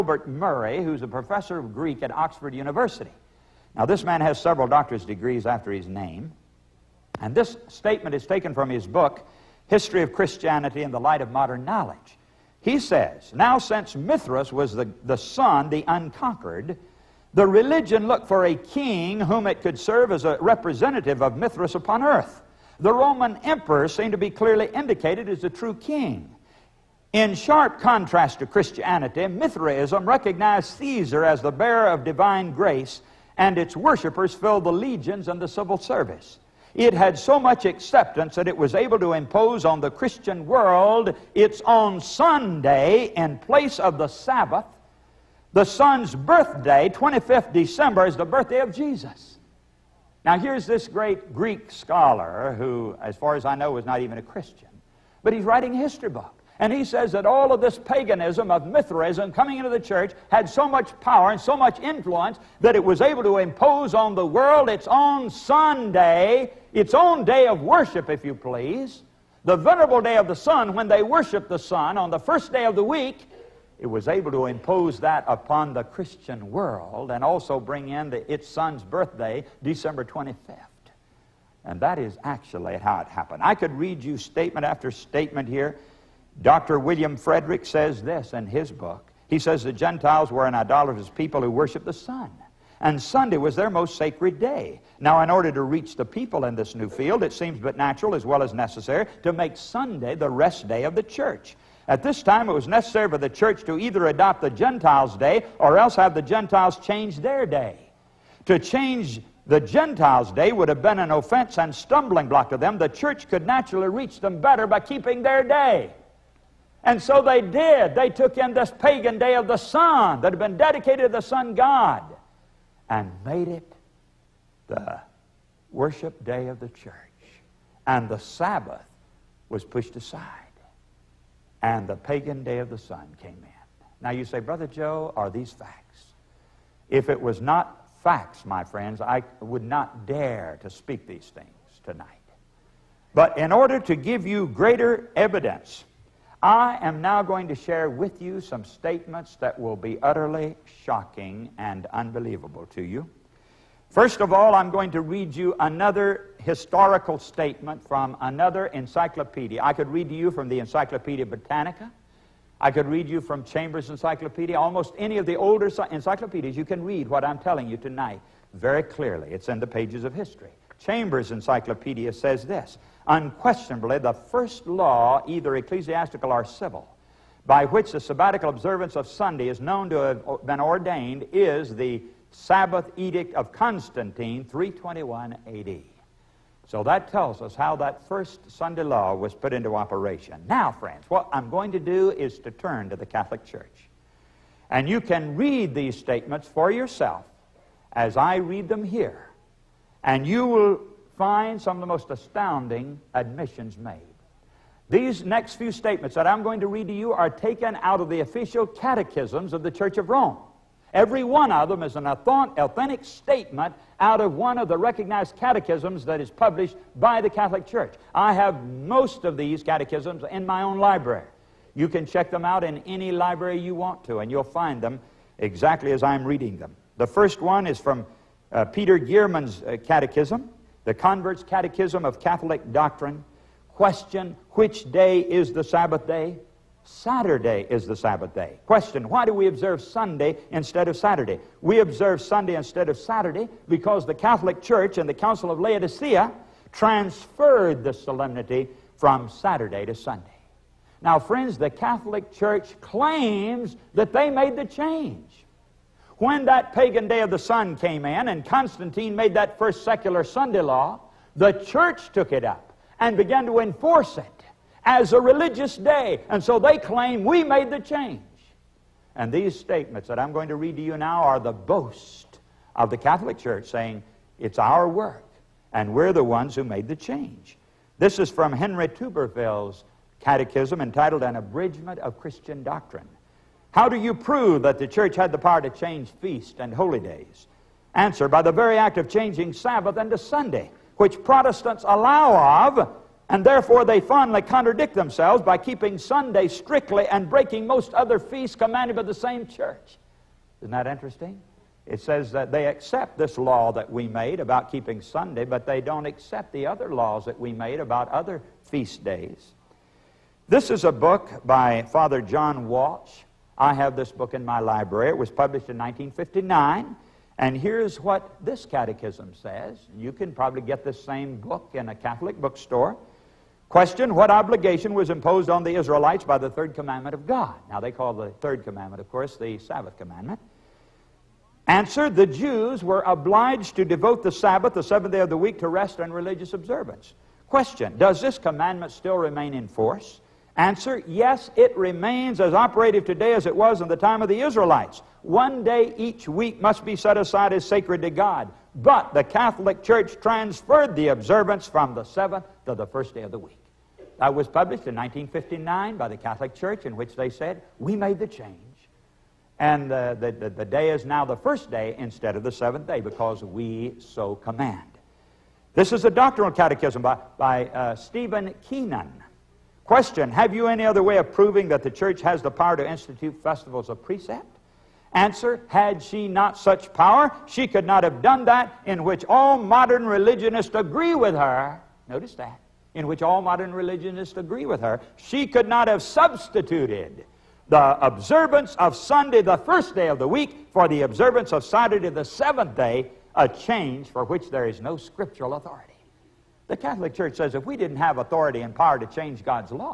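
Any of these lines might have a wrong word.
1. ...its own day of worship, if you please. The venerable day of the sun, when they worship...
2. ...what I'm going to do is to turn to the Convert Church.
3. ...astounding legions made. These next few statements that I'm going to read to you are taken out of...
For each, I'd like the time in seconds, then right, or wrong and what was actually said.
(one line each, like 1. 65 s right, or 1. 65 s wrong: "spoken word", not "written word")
1. 66 s right
2. 191 s wrong: "Catholic", not "Convert"
3. 202 s wrong: "admissions", not "legions".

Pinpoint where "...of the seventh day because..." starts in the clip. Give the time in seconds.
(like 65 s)
362 s.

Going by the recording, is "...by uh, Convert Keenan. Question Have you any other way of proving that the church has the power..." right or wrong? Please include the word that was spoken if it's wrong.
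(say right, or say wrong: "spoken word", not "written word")
wrong: "Stephen", not "Convert".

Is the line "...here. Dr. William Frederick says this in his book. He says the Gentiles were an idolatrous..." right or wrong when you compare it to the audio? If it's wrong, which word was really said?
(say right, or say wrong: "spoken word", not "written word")
right.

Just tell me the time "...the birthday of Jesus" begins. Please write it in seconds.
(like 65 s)
48 s.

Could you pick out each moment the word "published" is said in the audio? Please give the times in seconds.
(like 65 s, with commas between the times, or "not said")
216 s, 315 s, 354 s.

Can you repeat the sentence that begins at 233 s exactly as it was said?
Question Which day is the Sabbath day?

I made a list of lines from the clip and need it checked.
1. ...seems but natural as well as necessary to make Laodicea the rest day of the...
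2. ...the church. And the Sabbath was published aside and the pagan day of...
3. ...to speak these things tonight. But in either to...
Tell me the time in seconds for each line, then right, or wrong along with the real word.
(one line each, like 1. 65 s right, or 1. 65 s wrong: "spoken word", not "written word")
1. 97 s wrong: "Sunday", not "Laodicea"
2. 126 s wrong: "pushed", not "published"
3. 140 s wrong: "order", not "either".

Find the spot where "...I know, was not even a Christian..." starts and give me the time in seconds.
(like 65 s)
53 s.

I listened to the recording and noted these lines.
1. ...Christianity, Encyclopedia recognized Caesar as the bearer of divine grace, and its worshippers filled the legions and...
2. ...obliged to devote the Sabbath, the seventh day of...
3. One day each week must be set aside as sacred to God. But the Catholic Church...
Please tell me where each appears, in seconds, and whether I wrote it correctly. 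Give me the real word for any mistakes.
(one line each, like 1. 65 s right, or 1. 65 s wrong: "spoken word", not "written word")
1. 28 s wrong: "Mithraism", not "Encyclopedia"
2. 333 s right
3. 345 s right.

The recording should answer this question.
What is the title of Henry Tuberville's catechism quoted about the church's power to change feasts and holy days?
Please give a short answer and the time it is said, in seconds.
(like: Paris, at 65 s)
An Abridgment of Christian Doctrine, at 281 s.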